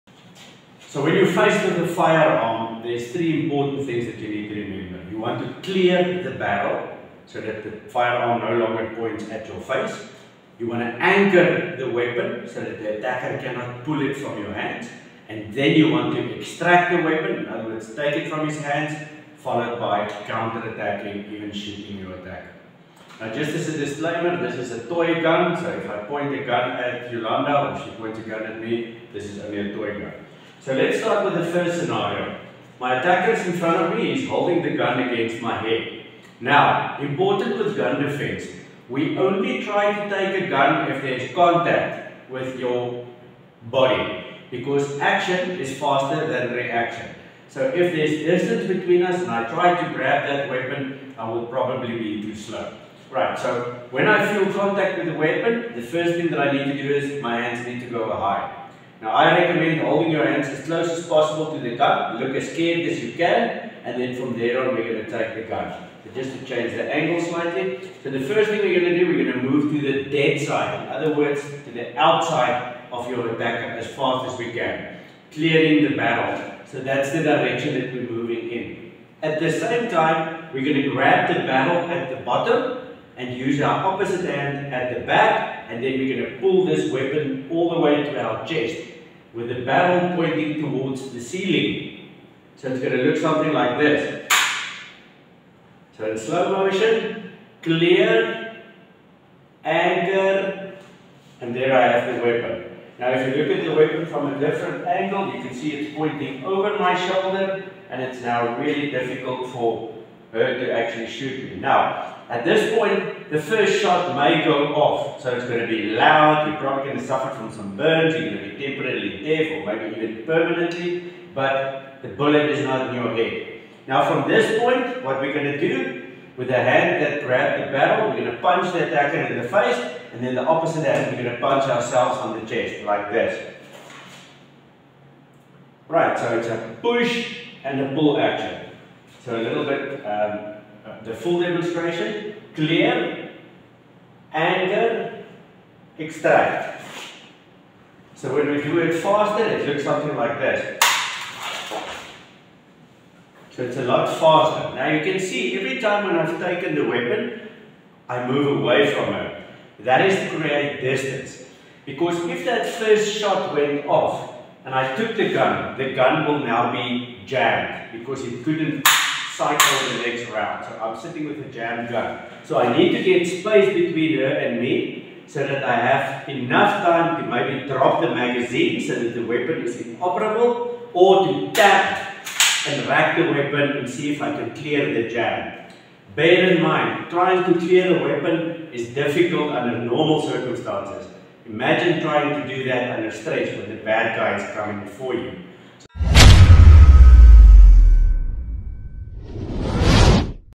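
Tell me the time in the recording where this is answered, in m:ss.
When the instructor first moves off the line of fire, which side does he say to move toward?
1:09.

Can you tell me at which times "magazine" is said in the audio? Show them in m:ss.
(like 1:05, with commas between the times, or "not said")
2:58.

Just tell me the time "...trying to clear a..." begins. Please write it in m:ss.
3:07.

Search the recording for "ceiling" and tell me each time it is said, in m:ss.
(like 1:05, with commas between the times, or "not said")
1:31.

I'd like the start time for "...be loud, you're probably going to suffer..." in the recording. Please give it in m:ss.
1:55.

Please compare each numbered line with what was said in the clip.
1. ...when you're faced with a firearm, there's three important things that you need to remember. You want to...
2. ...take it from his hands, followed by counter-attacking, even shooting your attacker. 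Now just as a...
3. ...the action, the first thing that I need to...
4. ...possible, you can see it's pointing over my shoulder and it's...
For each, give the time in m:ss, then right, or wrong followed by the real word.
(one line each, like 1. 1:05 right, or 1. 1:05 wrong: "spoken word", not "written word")
1. 0:01 right
2. 0:17 right
3. 0:55 wrong: "weapon", not "action"
4. 1:44 wrong: "angle", not "possible".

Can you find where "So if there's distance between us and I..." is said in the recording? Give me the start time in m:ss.
0:47.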